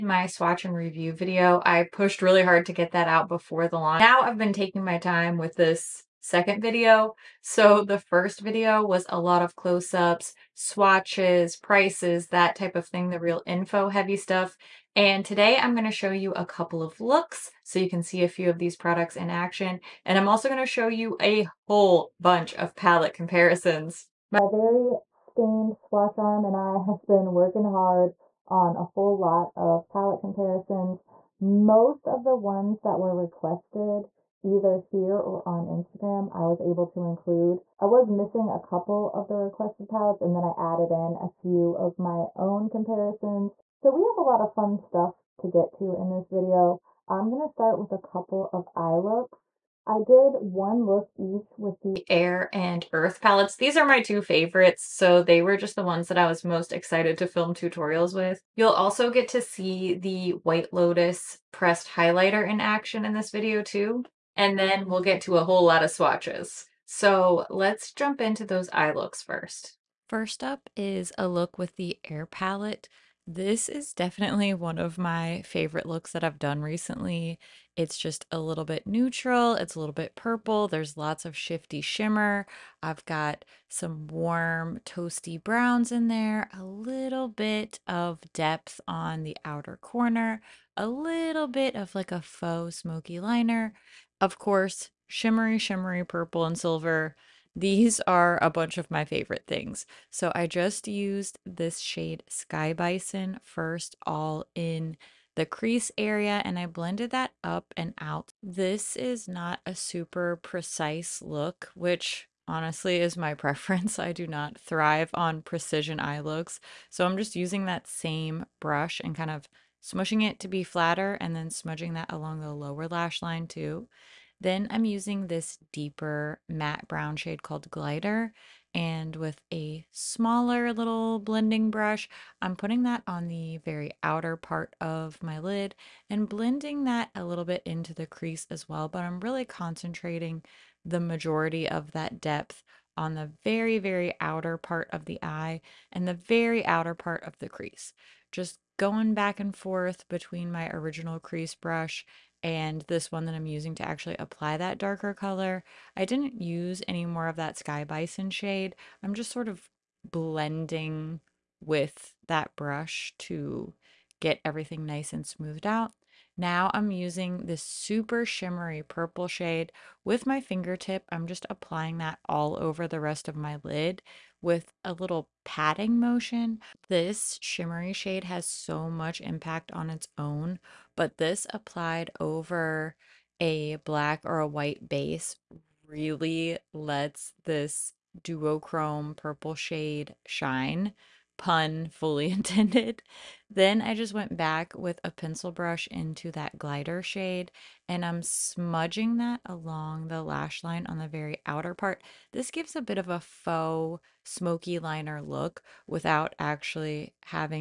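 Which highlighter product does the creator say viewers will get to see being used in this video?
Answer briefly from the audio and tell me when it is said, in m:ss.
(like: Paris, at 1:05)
White Lotus pressed highlighter, at 1:00.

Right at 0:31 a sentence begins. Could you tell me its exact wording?
Most of the ones that were requested either here or on Instagram, I was able to include.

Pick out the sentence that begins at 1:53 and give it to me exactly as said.
I do not thrive on precision eye looks.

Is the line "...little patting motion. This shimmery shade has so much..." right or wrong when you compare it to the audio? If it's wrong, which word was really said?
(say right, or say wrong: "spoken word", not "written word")
right.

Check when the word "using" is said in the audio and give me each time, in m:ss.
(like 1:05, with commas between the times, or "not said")
1:57, 2:04, 2:33, 2:46.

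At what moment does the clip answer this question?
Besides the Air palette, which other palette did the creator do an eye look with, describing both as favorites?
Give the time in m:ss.
0:52.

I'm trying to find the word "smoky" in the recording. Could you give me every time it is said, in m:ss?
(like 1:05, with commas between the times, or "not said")
1:32, 3:24.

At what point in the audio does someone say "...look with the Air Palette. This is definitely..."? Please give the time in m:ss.
1:11.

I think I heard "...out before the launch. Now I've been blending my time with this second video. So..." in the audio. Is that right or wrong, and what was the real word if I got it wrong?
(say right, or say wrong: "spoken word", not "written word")
wrong: "taking", not "blending".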